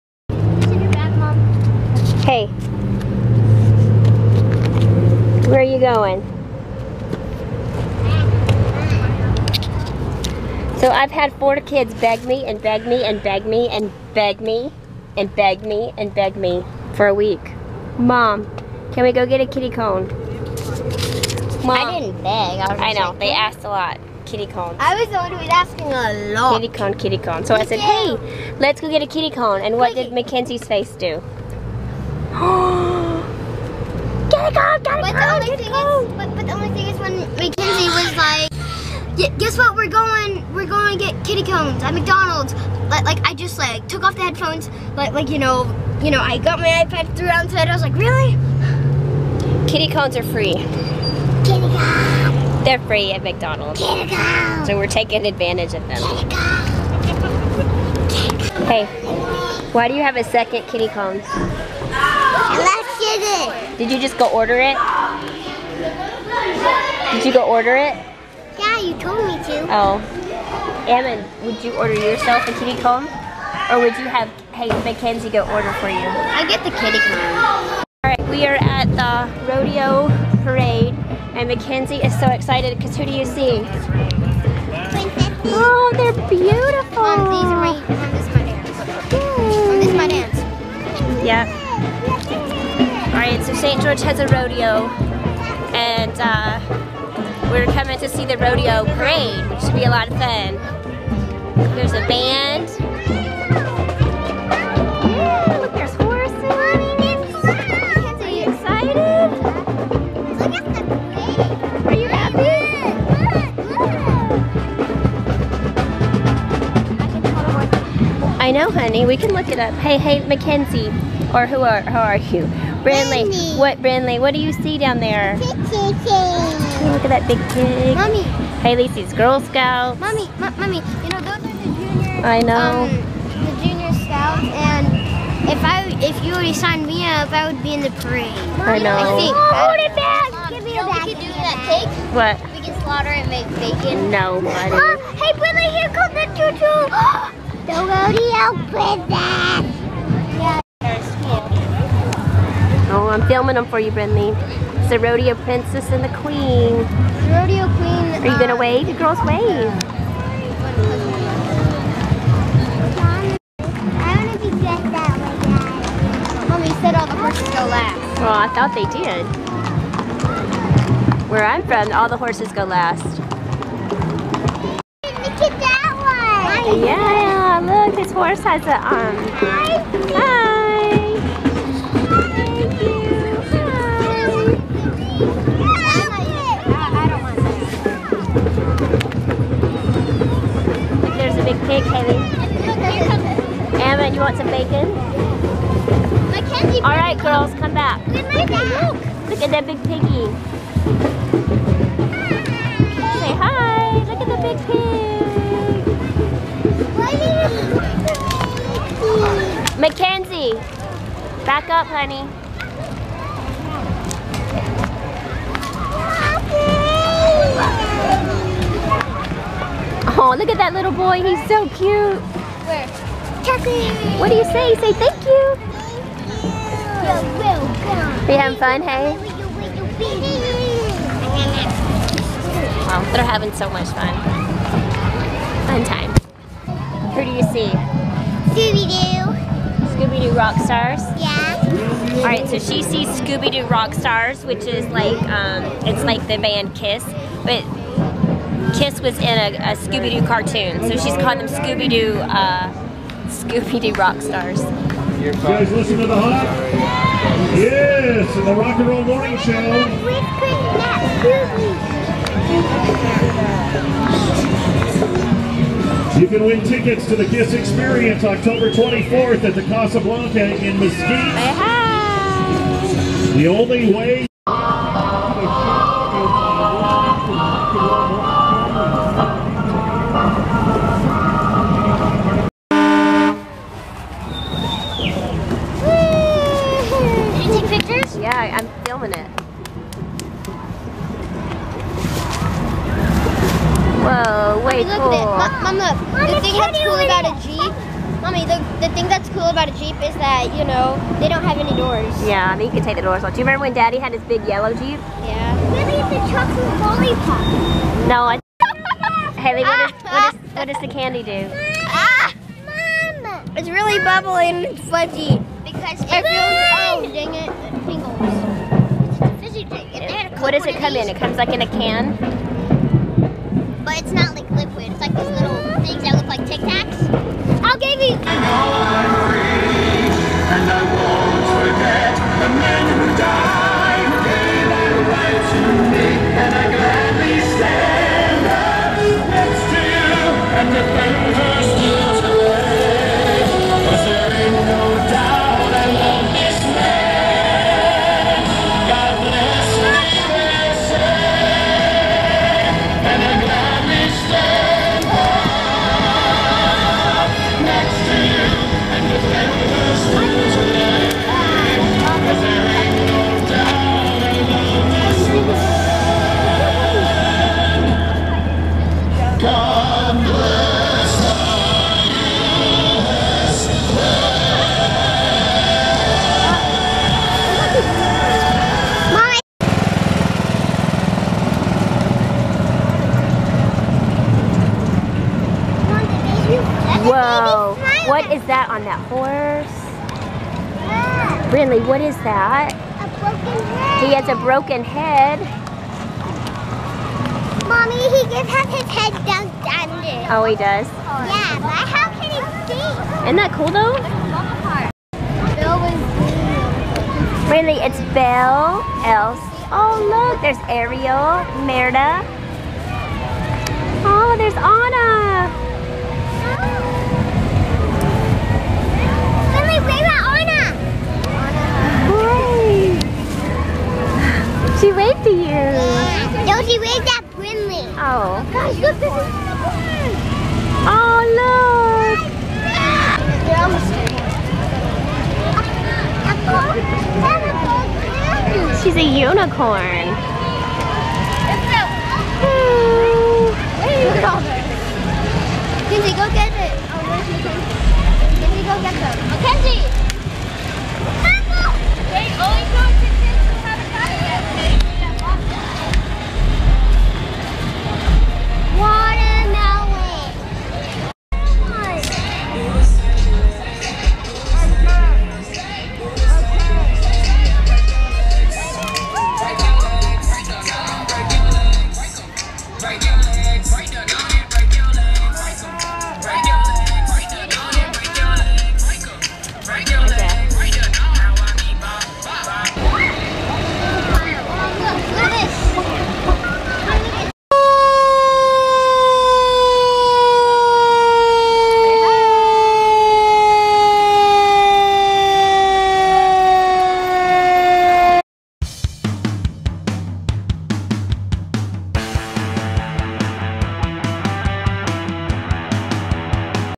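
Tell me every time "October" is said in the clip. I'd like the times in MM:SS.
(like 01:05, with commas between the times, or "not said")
04:28.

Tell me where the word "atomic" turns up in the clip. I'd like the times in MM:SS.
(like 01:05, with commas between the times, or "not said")
not said.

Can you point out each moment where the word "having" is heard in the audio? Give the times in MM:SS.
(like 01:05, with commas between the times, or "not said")
03:48, 03:53.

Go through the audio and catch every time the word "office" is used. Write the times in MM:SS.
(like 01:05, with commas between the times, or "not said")
not said.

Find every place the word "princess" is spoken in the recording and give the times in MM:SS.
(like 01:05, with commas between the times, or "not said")
02:28, 02:35.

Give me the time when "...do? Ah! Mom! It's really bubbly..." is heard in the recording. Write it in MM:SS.
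05:11.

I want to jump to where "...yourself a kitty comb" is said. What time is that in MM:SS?
01:11.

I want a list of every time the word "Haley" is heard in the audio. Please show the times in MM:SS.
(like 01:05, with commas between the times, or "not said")
02:08, 05:09.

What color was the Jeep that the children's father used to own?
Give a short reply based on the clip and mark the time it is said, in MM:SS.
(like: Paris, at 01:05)
yellow, at 05:04.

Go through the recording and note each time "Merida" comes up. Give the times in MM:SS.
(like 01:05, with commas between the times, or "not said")
06:51.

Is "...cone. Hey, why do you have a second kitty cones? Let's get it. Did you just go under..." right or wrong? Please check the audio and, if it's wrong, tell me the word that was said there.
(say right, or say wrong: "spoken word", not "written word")
wrong: "order", not "under".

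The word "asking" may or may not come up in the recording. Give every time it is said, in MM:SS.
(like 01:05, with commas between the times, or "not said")
00:25.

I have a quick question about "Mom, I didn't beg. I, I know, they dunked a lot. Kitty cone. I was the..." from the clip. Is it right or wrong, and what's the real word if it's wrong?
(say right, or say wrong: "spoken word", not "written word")
wrong: "asked", not "dunked".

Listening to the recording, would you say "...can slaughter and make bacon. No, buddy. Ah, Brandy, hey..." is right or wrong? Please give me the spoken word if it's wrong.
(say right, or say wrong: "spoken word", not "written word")
wrong: "Mom", not "Brandy".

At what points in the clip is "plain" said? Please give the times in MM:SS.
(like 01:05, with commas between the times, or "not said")
not said.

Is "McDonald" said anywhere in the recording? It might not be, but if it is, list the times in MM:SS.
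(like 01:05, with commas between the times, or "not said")
00:41, 00:53.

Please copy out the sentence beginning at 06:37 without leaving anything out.
Mommy, he just has his head dunked under.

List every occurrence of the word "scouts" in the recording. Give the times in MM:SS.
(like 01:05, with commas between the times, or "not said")
02:09, 02:13.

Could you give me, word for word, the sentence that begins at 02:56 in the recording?
Yeah, look, this horse has a um.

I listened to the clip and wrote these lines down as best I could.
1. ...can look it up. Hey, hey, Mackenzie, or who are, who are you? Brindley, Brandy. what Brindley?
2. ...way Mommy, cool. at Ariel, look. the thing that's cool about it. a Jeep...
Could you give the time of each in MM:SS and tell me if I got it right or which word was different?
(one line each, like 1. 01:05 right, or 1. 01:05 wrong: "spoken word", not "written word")
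1. 01:59 right
2. 04:54 wrong: "Mom", not "Ariel".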